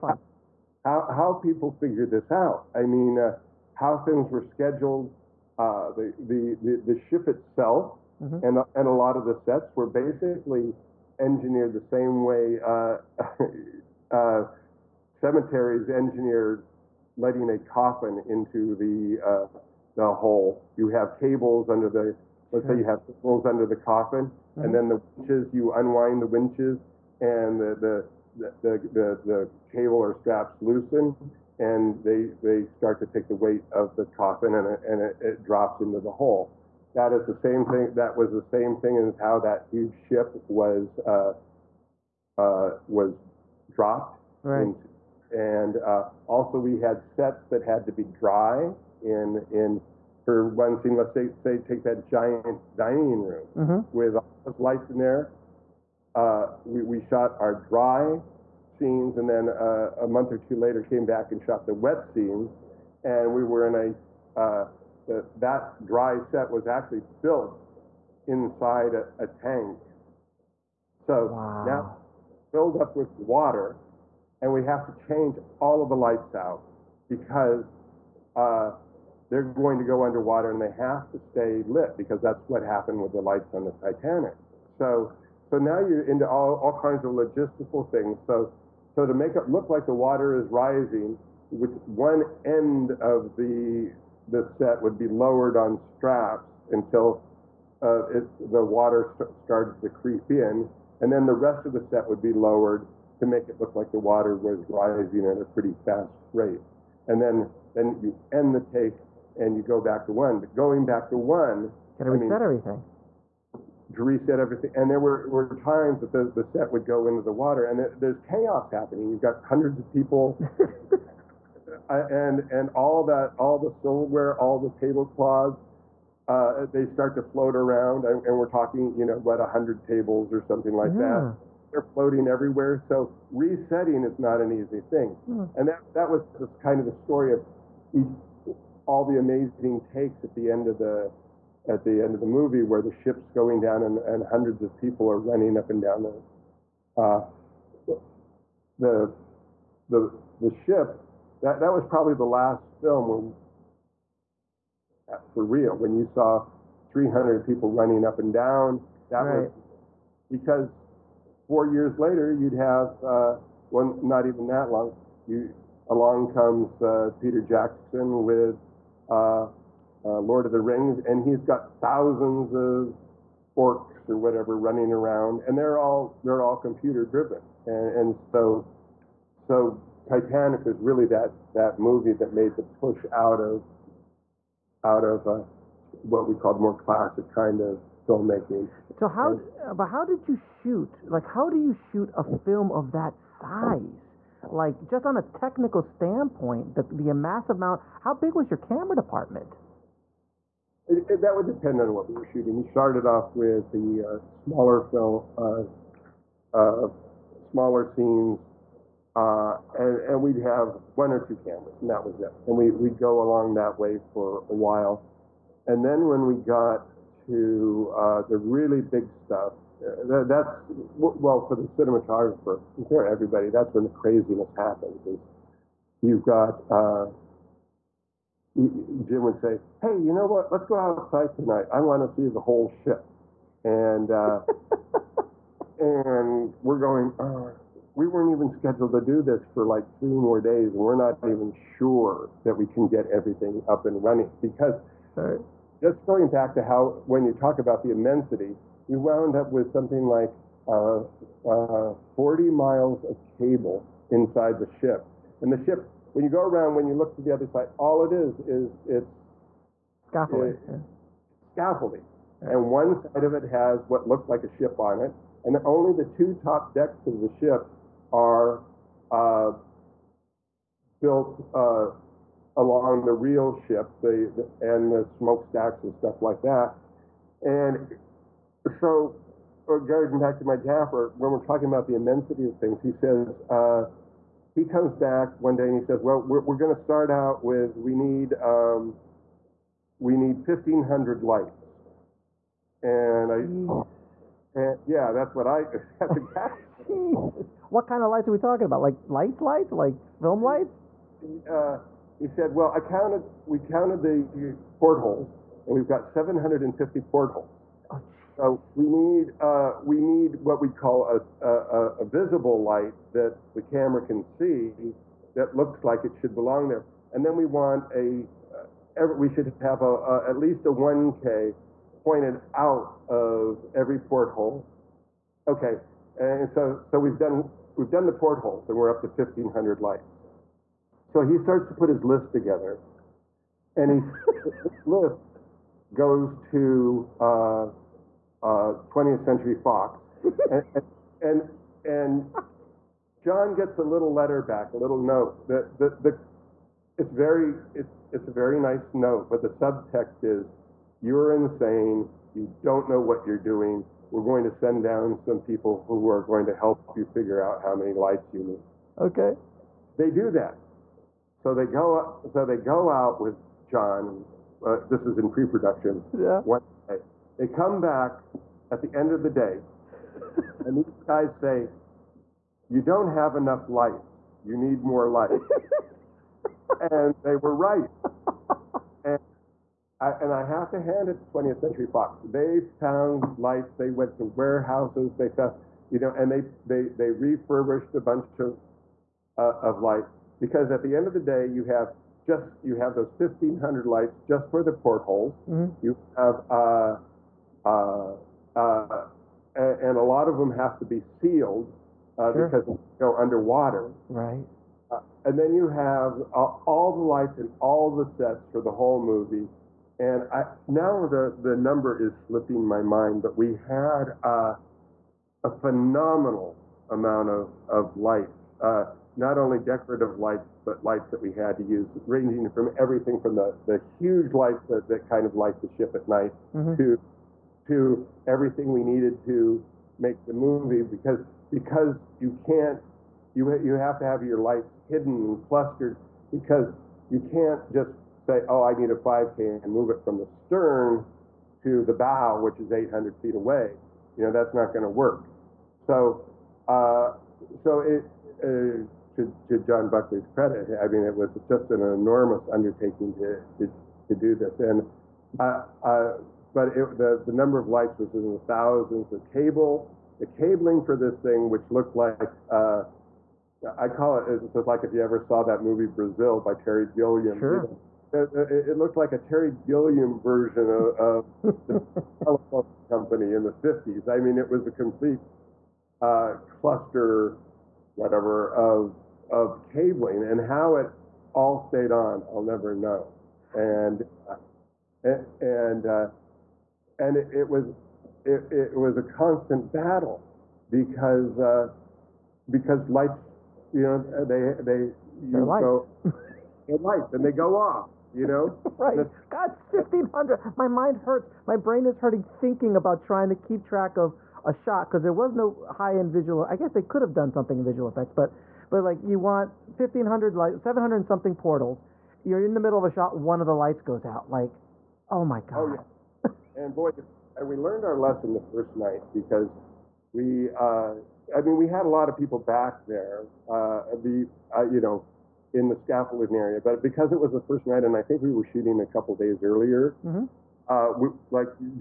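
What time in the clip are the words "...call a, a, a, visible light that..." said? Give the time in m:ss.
5:10.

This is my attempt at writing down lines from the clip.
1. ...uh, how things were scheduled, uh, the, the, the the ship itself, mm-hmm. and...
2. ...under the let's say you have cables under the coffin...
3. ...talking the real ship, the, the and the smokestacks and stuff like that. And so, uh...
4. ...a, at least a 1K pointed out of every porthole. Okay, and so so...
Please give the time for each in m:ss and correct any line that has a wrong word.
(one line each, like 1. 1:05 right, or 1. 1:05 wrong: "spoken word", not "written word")
1. 0:03 right
2. 0:21 right
3. 4:32 wrong: "along", not "talking"
4. 5:19 right.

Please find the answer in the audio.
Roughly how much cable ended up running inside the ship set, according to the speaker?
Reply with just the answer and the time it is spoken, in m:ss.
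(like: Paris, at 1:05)
40 miles, at 4:12.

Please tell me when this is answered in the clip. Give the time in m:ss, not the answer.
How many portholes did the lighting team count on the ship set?
5:06.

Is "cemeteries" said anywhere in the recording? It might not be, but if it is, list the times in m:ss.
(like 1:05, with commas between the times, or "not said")
0:15.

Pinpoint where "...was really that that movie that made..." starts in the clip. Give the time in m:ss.
3:00.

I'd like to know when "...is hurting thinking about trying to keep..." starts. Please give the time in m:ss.
8:21.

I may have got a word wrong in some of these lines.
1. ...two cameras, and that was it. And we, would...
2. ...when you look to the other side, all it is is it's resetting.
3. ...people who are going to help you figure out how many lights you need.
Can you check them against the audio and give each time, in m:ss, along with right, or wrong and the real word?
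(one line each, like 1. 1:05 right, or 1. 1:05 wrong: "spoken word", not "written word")
1. 3:31 right
2. 4:16 wrong: "scaffolding", not "resetting"
3. 5:55 right.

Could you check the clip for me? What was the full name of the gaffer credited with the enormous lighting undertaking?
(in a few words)
John Buckley.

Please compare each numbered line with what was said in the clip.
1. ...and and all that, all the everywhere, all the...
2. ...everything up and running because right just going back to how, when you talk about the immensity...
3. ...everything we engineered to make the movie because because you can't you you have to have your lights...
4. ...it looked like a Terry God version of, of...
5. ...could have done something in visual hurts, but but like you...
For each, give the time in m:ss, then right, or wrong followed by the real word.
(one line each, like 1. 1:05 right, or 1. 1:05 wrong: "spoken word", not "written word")
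1. 2:01 wrong: "silverware", not "everywhere"
2. 4:03 right
3. 7:08 wrong: "needed", not "engineered"
4. 7:48 wrong: "Gilliam", not "God"
5. 8:26 wrong: "effects", not "hurts".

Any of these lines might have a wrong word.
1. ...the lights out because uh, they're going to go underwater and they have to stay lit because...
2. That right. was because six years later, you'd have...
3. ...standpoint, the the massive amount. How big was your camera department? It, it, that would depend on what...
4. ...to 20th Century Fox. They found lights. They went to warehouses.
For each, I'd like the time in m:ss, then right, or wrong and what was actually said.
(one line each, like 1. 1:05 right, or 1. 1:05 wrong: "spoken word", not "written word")
1. 1:15 right
2. 2:39 wrong: "four", not "six"
3. 3:15 right
4. 6:21 right.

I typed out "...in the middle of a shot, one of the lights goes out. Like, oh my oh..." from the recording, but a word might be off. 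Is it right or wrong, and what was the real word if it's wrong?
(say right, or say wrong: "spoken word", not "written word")
right.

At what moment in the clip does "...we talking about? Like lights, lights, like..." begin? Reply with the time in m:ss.
4:58.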